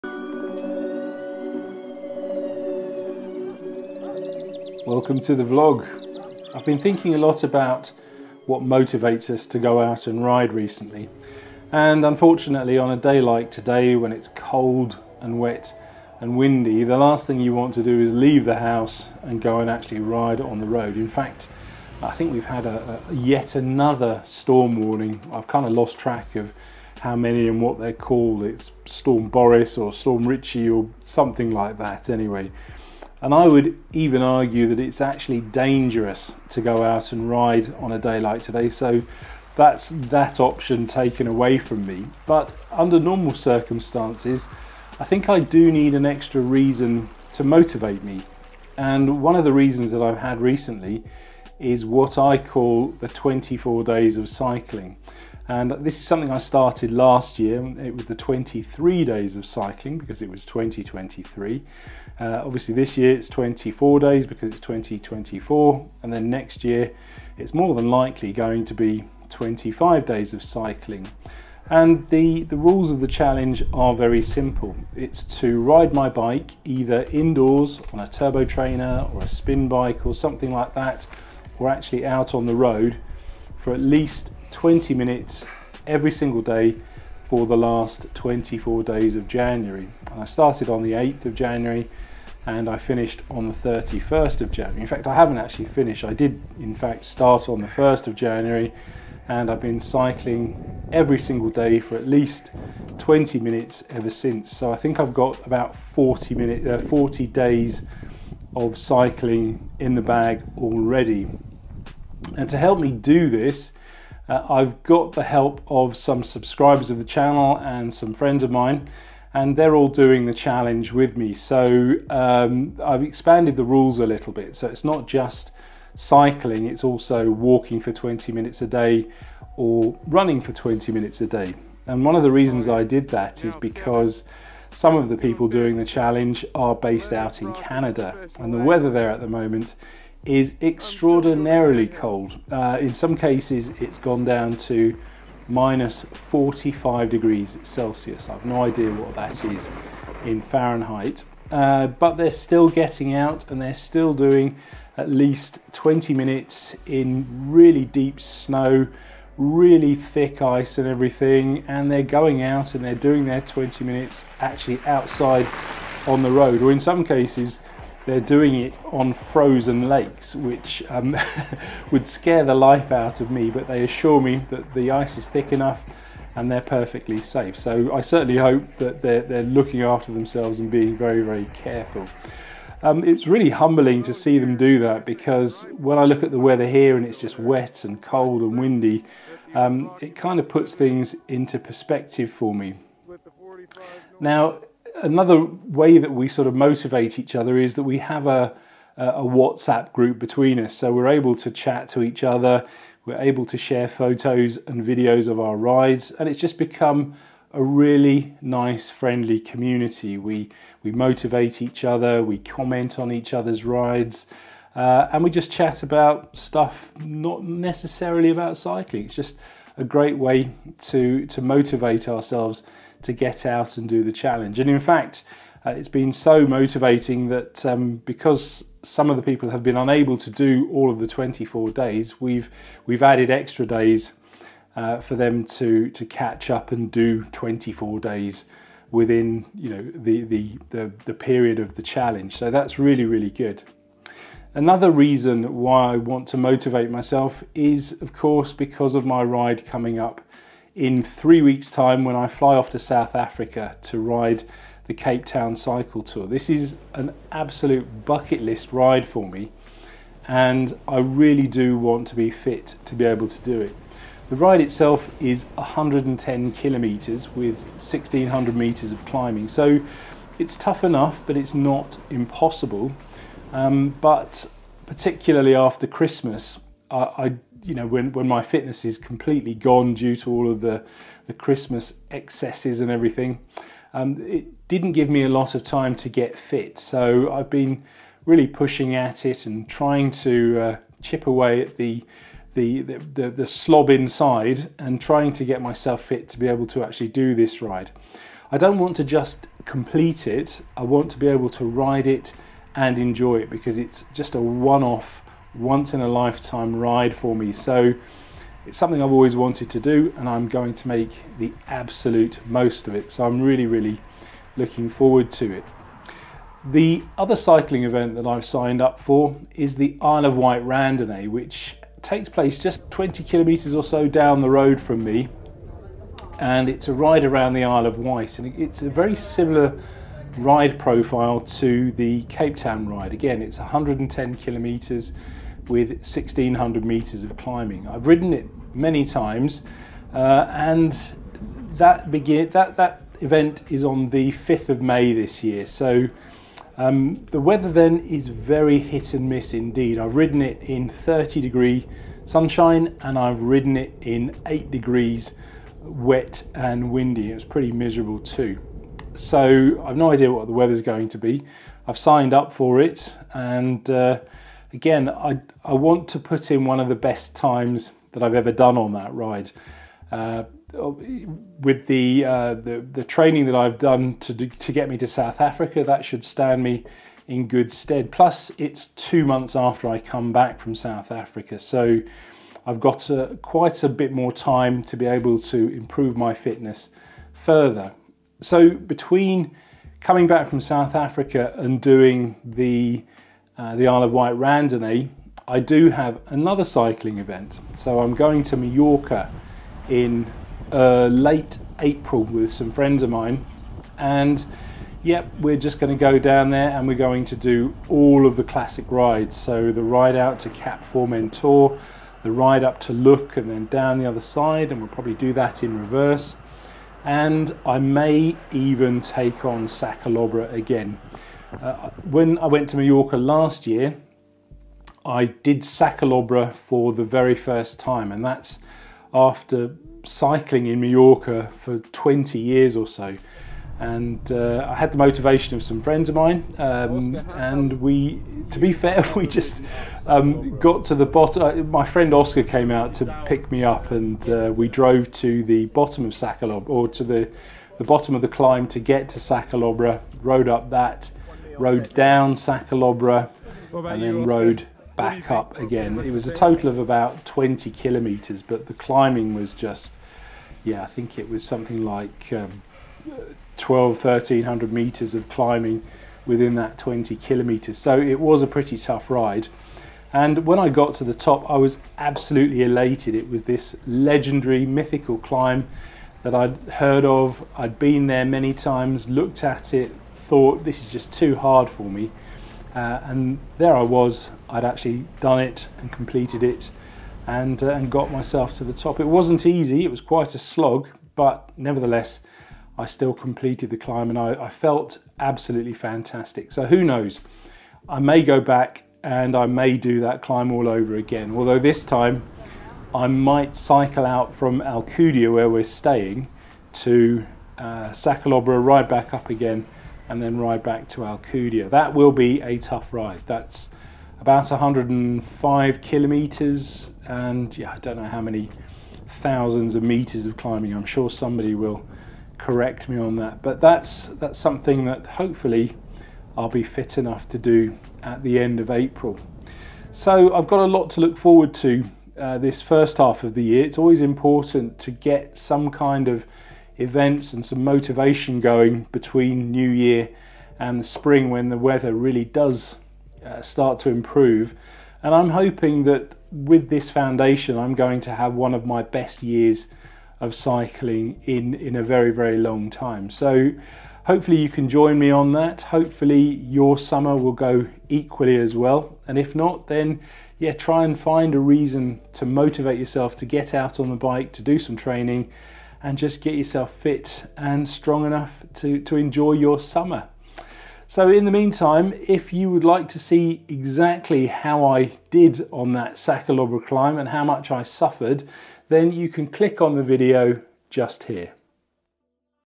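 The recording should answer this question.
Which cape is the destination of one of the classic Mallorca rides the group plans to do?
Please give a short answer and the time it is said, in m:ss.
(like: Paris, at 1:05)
Cap Formentor, at 6:50.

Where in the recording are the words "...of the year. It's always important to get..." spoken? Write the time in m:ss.
8:53.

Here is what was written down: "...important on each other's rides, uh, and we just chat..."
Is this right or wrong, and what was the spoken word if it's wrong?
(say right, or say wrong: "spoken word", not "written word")
wrong: "comment", not "important".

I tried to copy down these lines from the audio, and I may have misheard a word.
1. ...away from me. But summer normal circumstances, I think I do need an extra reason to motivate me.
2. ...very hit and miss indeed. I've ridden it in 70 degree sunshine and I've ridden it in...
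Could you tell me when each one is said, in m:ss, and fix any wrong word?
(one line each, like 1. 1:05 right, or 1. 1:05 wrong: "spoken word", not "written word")
1. 0:41 wrong: "under", not "summer"
2. 5:48 wrong: "30", not "70".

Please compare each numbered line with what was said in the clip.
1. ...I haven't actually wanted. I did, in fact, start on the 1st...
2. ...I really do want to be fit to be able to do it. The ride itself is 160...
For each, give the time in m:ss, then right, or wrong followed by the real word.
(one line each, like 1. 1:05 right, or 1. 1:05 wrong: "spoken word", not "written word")
1. 1:35 wrong: "finished", not "wanted"
2. 4:20 wrong: "110", not "160".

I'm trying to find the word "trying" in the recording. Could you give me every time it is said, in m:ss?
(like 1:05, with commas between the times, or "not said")
4:49, 4:55.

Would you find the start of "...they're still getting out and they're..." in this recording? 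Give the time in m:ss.
2:32.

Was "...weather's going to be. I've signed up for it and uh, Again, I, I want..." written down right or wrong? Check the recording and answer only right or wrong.
right.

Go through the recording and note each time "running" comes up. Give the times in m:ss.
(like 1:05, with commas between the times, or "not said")
2:10.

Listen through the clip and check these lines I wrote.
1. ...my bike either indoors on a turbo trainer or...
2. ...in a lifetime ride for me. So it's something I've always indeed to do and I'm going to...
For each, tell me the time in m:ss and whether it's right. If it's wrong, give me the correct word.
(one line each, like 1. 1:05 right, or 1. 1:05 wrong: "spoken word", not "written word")
1. 1:15 right
2. 5:05 wrong: "wanted", not "indeed".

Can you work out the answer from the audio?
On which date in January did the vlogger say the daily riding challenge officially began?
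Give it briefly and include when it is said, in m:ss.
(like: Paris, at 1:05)
8th of January, at 1:30.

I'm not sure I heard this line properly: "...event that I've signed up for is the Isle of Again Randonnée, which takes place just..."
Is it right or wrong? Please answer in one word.
wrong.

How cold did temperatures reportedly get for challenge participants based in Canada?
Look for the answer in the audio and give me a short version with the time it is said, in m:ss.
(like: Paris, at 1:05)
minus 45 degrees Celsius, at 2:25.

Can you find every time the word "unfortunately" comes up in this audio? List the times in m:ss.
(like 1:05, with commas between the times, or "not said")
0:12.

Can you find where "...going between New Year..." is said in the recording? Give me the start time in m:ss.
8:58.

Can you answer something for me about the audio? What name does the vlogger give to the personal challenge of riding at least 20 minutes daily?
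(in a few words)
24 days of cycling.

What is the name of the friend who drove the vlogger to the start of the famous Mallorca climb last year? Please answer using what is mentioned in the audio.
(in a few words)
Oscar.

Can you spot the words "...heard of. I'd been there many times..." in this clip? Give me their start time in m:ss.
7:56.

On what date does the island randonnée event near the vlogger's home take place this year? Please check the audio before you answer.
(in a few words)
5th of May.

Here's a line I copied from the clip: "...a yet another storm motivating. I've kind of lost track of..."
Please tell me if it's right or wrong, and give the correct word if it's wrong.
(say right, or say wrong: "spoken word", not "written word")
wrong: "warning", not "motivating".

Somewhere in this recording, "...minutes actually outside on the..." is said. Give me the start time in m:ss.
2:43.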